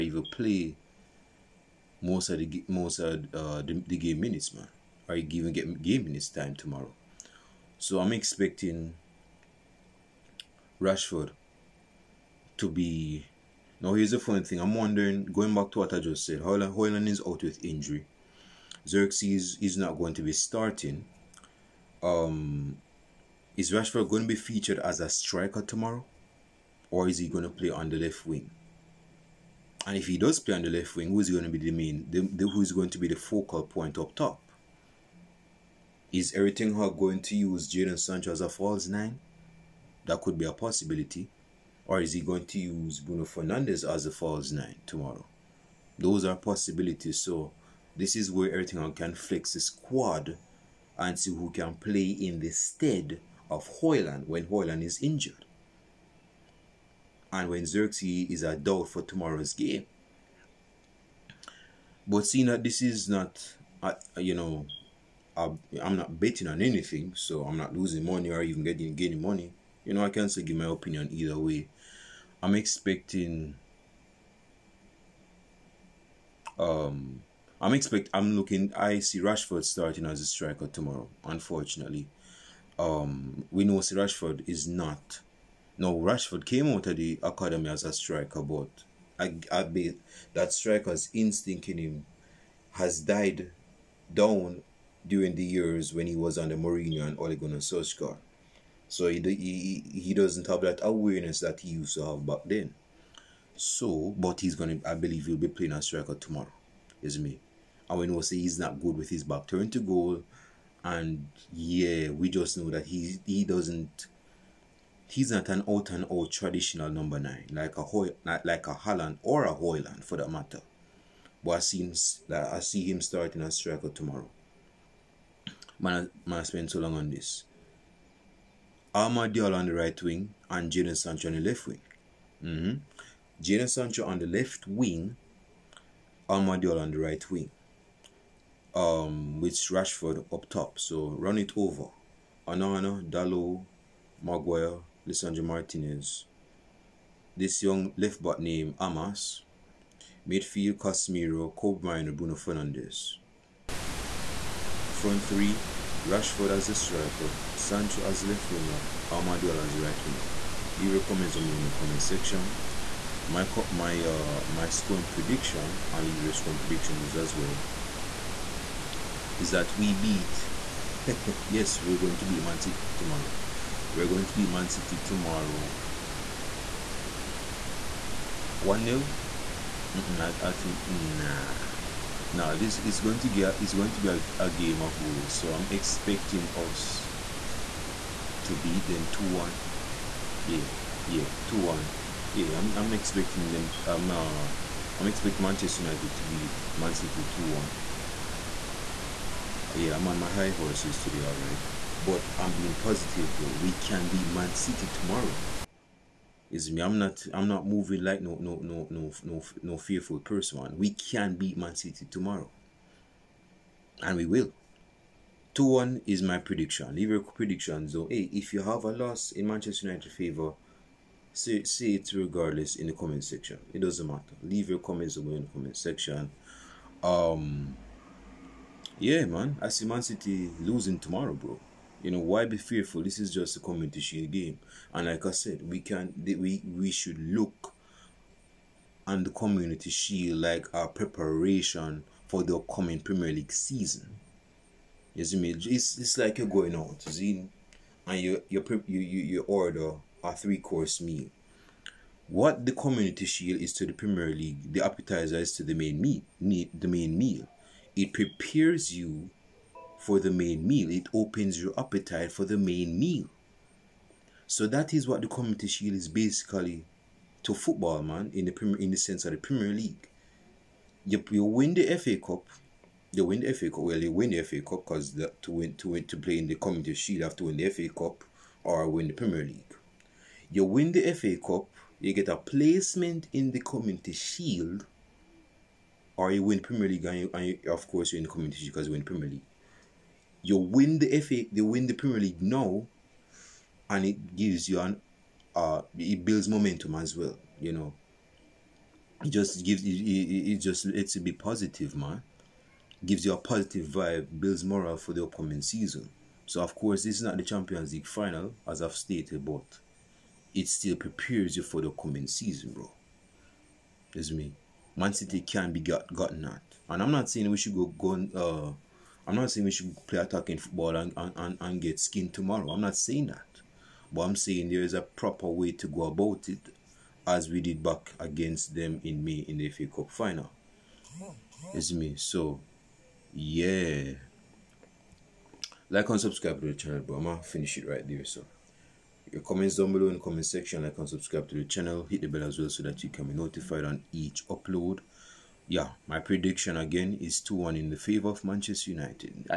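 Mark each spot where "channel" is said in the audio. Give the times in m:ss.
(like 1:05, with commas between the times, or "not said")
5:36, 5:41.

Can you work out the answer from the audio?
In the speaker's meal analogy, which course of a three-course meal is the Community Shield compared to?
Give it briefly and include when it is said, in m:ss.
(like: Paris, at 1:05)
the appetizer, at 4:14.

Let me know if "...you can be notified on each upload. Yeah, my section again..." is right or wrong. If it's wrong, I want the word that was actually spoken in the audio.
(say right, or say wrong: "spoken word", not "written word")
wrong: "prediction", not "section".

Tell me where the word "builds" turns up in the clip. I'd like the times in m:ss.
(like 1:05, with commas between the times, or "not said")
4:56, 5:04.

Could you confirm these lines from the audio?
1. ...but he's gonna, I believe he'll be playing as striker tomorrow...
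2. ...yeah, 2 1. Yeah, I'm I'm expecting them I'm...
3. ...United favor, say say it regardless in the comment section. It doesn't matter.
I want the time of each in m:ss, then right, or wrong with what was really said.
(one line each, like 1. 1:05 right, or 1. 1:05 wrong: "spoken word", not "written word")
1. 1:44 right
2. 3:11 right
3. 3:39 right.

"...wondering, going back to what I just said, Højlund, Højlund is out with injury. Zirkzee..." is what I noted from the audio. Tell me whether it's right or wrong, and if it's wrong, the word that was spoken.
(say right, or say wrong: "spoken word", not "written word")
right.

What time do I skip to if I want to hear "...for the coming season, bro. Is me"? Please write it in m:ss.
5:11.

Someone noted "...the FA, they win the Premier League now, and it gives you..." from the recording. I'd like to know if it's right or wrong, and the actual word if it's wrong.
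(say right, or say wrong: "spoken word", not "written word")
right.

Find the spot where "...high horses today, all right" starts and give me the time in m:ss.
3:20.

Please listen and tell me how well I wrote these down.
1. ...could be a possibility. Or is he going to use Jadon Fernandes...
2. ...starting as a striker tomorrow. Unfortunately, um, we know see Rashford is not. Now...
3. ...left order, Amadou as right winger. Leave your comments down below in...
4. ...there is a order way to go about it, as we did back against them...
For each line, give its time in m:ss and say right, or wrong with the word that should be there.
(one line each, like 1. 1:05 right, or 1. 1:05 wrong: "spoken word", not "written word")
1. 0:40 wrong: "Bruno", not "Jadon"
2. 1:19 right
3. 2:38 wrong: "winger", not "order"
4. 5:24 wrong: "proper", not "order".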